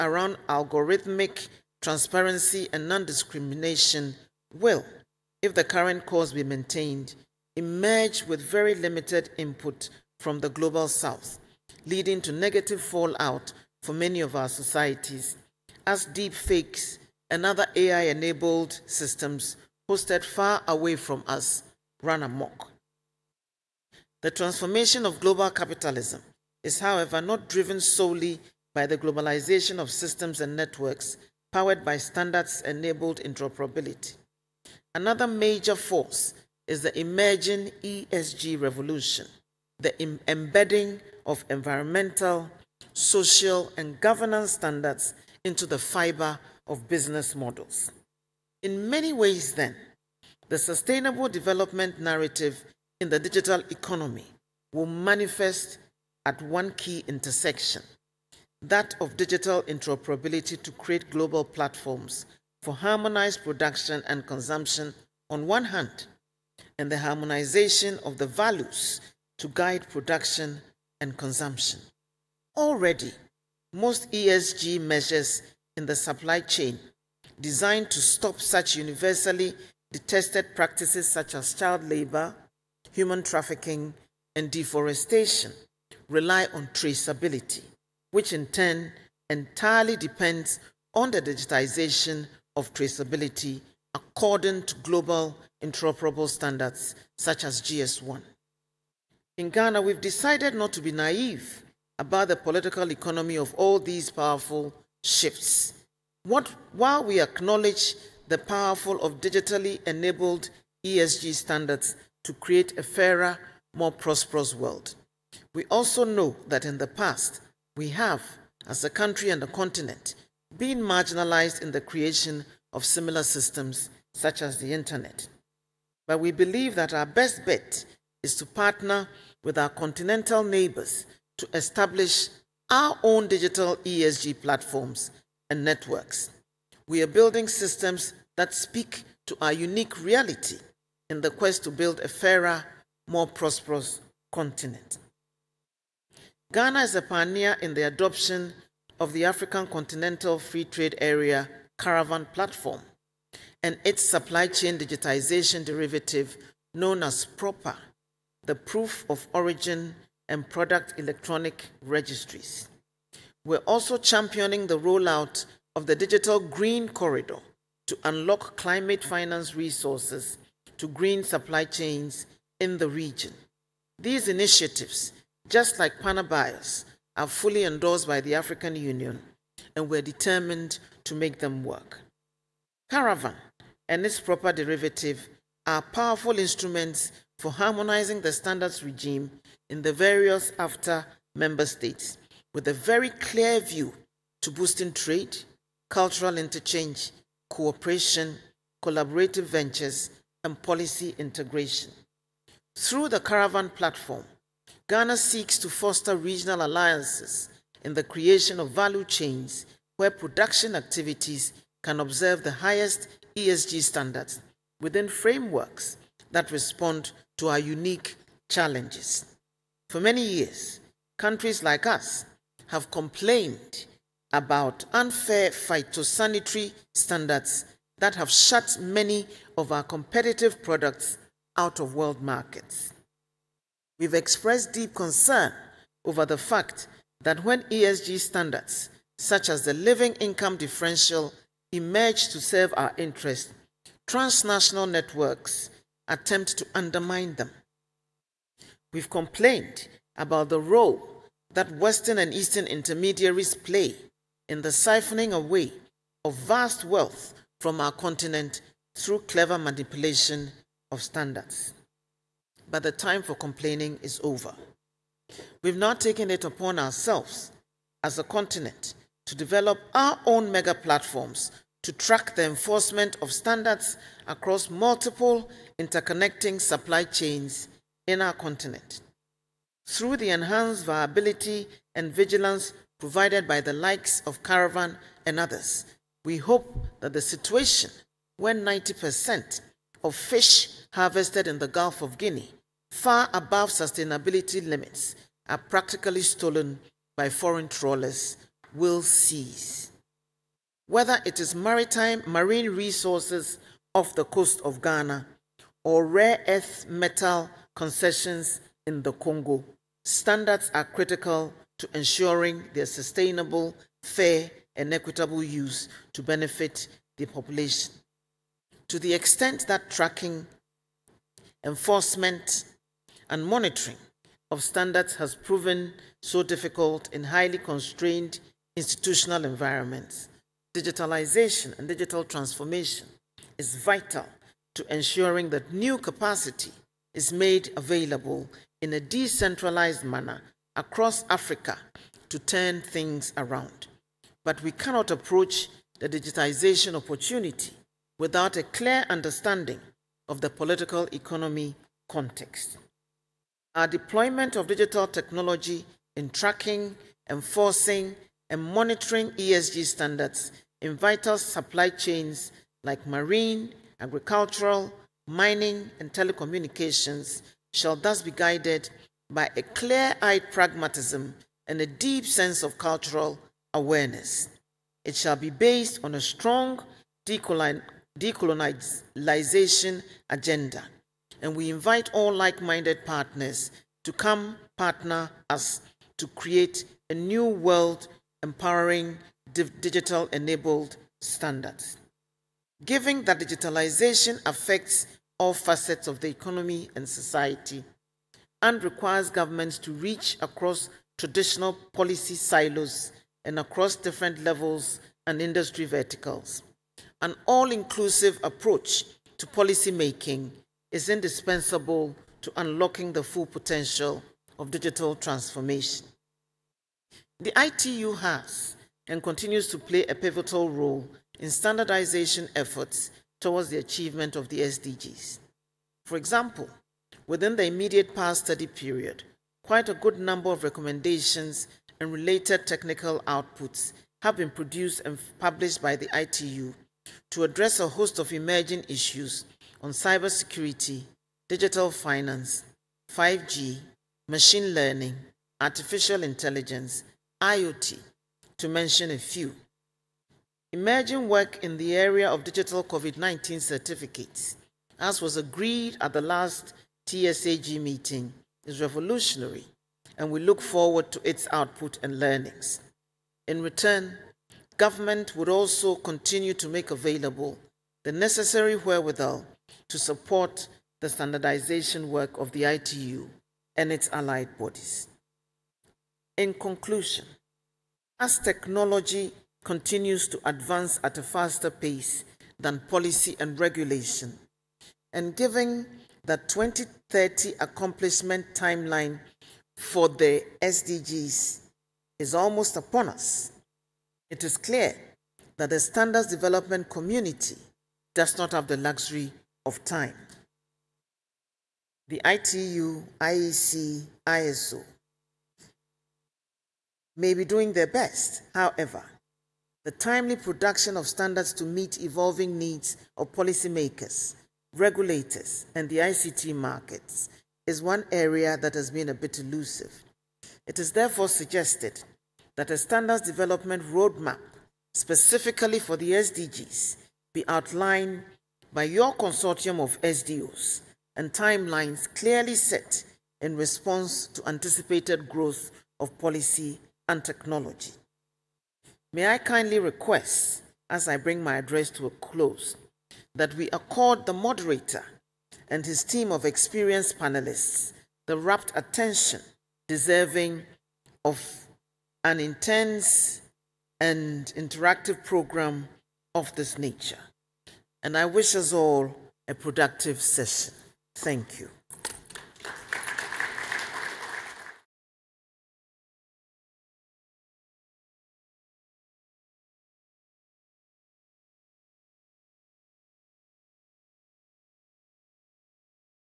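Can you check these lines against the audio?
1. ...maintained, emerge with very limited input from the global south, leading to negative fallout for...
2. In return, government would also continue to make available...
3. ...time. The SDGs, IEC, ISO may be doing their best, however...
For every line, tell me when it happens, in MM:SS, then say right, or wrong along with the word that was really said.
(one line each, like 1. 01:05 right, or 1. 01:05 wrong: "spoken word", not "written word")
1. 00:06 right
2. 07:43 right
3. 08:19 wrong: "ITU", not "SDGs".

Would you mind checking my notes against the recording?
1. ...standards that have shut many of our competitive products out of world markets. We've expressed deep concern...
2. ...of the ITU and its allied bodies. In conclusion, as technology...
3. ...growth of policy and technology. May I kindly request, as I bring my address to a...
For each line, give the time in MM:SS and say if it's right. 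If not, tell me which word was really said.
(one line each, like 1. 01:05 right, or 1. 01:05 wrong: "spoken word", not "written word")
1. 03:46 right
2. 07:52 right
3. 08:55 right.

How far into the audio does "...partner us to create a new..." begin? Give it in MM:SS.
06:24.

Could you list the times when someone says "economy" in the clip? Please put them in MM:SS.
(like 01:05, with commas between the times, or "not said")
00:53, 01:42, 05:51, 06:36.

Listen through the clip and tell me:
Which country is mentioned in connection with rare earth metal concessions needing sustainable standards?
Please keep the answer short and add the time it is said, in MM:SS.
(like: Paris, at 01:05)
Congo, at 05:09.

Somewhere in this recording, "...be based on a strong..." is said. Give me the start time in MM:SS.
06:15.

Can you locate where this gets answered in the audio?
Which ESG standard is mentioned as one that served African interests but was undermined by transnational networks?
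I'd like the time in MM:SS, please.
03:59.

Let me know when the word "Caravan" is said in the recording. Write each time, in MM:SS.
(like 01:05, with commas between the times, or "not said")
02:31, 03:02, 03:23, 04:44.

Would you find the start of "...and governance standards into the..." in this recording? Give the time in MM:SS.
00:43.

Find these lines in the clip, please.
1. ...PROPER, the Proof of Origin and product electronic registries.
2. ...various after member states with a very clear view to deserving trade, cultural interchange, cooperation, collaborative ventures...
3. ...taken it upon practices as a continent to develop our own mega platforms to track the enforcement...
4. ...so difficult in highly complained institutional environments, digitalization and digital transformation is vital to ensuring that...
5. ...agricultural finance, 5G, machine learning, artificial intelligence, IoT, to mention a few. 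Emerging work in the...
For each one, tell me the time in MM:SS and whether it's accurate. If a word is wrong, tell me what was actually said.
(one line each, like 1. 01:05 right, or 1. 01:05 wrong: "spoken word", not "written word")
1. 02:37 right
2. 03:09 wrong: "boosting", not "deserving"
3. 04:25 wrong: "ourselves", not "practices"
4. 05:26 wrong: "constrained", not "complained"
5. 07:21 wrong: "digital", not "agricultural".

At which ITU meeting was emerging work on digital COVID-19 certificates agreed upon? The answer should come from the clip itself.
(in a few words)
TSAG.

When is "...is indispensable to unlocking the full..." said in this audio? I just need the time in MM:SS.
06:50.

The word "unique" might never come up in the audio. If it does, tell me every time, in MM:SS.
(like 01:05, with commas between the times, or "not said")
02:19, 03:37.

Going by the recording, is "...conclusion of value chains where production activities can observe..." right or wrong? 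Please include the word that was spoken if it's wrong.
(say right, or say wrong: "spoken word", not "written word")
wrong: "creation", not "conclusion".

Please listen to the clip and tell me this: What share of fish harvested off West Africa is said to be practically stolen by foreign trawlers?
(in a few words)
90%.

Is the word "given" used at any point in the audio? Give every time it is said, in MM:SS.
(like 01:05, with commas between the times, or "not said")
06:32, 08:05.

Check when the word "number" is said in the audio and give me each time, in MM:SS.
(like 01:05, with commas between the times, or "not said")
07:10.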